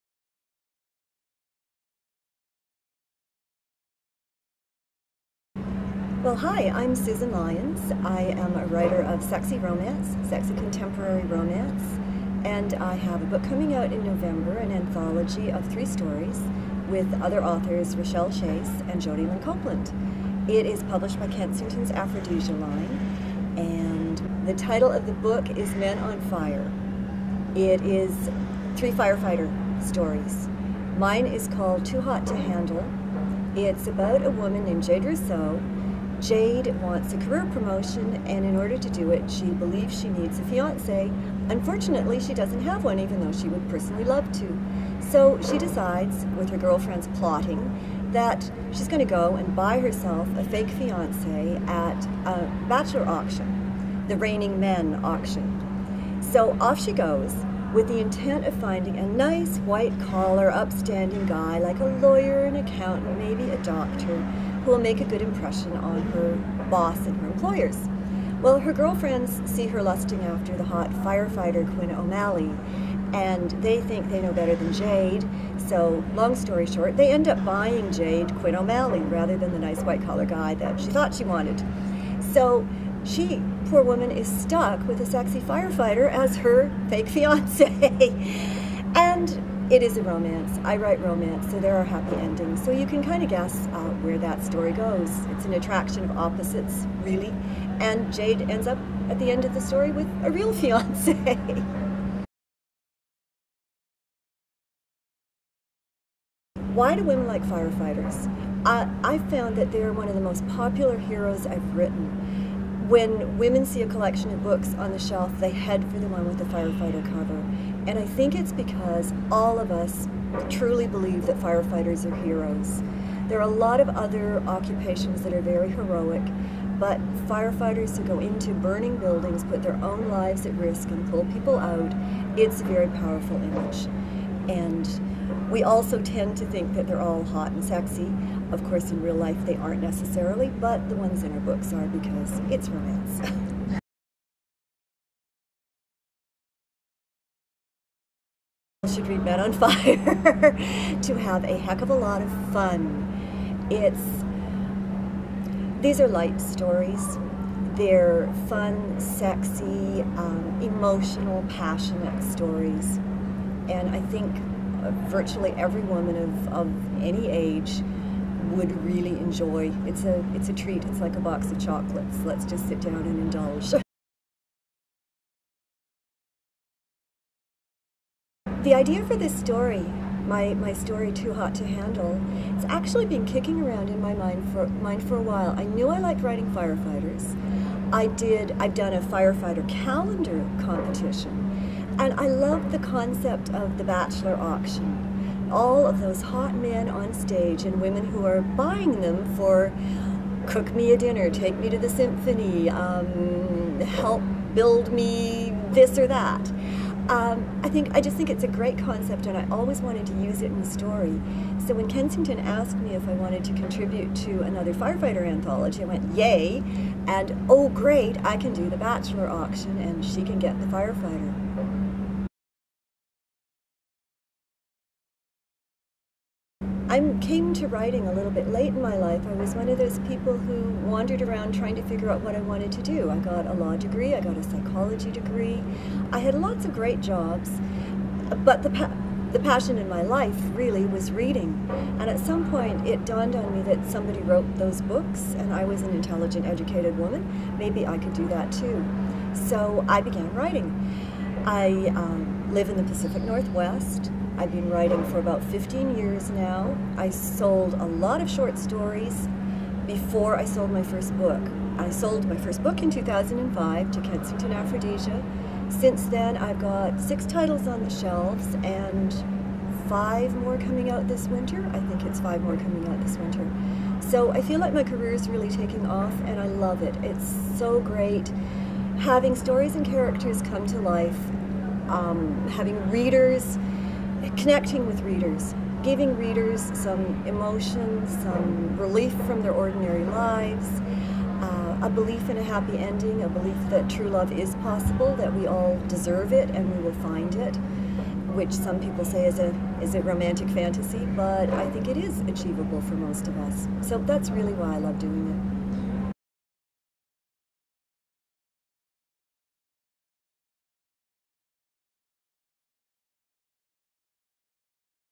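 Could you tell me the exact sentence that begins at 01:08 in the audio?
Well, her girlfriends see her lusting after the hot firefighter Quinn O'Malley, and they think they know better than Jade.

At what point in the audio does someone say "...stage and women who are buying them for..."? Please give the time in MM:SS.
03:17.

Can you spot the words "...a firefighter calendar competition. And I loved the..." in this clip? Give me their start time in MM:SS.
03:08.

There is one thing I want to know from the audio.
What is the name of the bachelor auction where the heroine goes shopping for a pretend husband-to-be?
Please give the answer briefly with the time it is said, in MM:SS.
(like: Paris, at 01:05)
Reigning Men, at 00:54.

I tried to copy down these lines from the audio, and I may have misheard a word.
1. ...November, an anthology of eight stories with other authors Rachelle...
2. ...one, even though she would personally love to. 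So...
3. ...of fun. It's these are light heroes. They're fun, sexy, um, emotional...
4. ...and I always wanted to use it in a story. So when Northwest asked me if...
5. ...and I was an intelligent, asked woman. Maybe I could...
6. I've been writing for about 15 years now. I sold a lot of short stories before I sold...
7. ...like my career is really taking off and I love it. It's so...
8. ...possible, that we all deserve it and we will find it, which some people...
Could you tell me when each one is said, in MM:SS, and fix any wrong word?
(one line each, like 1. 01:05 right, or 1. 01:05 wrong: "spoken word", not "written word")
1. 00:14 wrong: "three", not "eight"
2. 00:42 right
3. 02:32 wrong: "stories", not "heroes"
4. 03:29 wrong: "Kensington", not "Northwest"
5. 04:05 wrong: "educated", not "asked"
6. 04:14 right
7. 04:34 right
8. 04:54 right.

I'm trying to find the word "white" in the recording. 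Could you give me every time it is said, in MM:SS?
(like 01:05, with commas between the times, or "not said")
00:59, 01:19.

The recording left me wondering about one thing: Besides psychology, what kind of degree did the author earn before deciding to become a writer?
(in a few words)
law degree.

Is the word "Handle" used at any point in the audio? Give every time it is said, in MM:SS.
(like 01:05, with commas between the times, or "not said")
00:32, 03:01.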